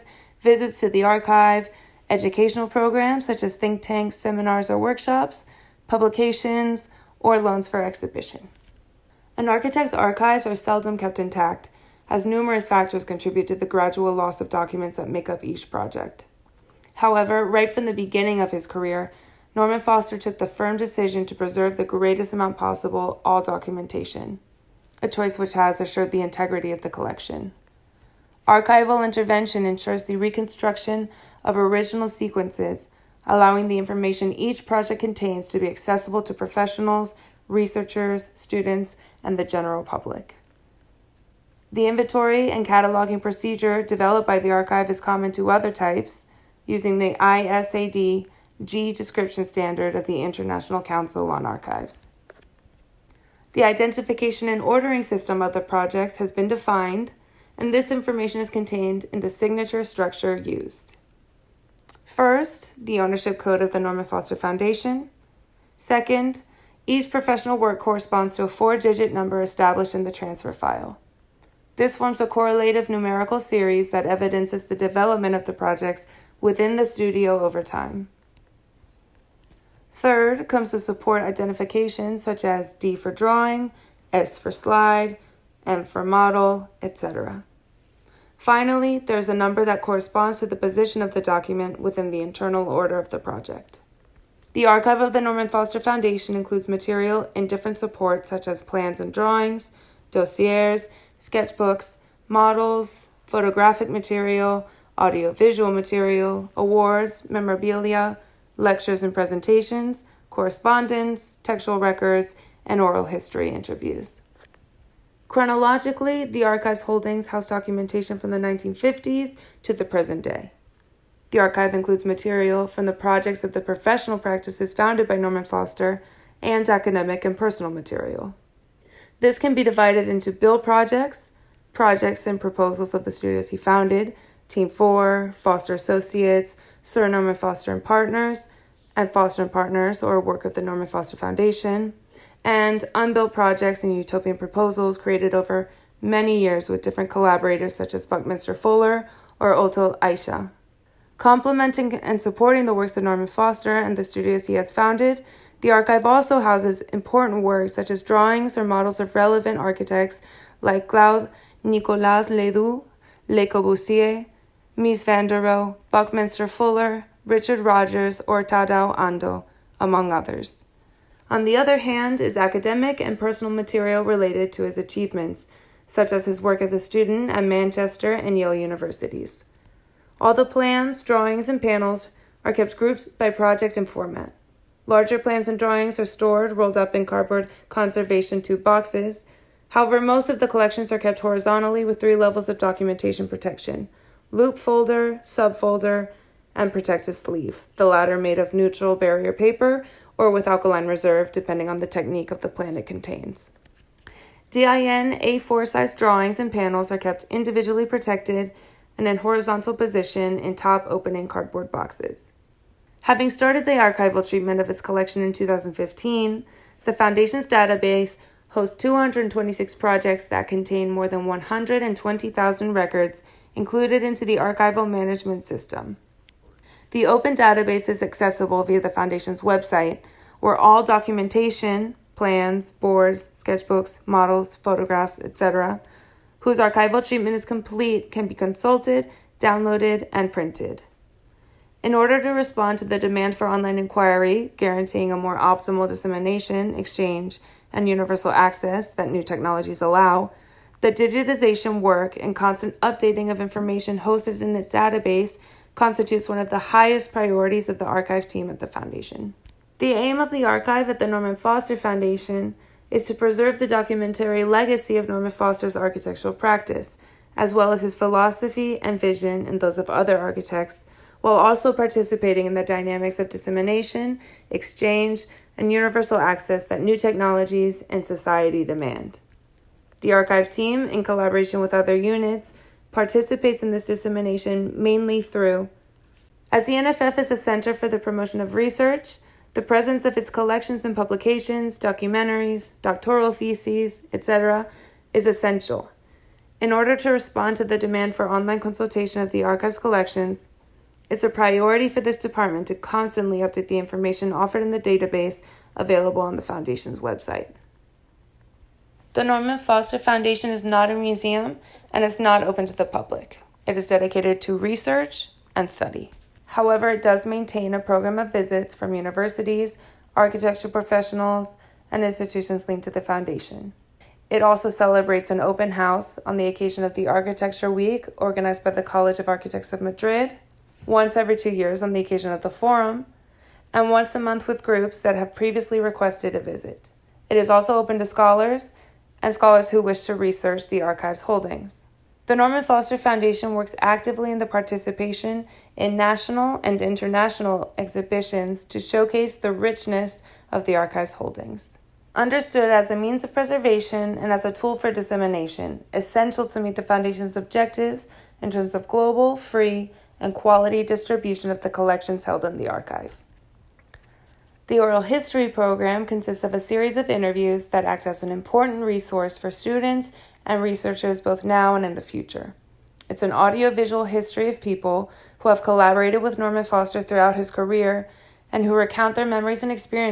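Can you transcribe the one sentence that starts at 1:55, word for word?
Chronologically, the archive's holdings house documentation from the 1950s to the present day.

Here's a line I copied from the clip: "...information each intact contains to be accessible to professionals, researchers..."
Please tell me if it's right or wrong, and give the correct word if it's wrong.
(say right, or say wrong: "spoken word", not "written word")
wrong: "project", not "intact".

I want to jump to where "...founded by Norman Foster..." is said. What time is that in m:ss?
2:04.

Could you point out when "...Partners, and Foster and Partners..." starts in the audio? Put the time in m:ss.
2:17.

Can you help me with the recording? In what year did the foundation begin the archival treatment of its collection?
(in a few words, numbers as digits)
2015.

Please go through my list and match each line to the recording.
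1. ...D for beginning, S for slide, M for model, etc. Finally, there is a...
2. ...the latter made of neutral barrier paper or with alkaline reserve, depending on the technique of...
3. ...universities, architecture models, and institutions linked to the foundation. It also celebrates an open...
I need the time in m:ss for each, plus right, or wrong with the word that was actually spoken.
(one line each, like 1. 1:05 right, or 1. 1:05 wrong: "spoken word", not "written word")
1. 1:22 wrong: "drawing", not "beginning"
2. 3:17 right
3. 5:18 wrong: "professionals", not "models".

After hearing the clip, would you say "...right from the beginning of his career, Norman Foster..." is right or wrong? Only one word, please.
right.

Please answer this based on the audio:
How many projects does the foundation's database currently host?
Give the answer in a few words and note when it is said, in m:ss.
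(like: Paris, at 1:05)
226, at 3:38.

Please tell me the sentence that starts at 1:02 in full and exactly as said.
First, the ownership code of the Norman Foster Foundation.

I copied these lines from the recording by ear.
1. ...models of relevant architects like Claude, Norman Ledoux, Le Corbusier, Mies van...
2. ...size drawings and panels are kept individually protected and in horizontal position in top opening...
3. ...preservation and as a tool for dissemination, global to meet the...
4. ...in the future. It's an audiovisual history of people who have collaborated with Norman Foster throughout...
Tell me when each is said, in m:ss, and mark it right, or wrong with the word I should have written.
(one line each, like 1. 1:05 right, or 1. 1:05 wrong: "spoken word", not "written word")
1. 2:38 wrong: "Nicolas", not "Norman"
2. 3:25 right
3. 5:53 wrong: "essential", not "global"
4. 6:11 right.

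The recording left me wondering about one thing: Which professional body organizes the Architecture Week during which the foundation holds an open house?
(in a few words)
College of Architects of Madrid.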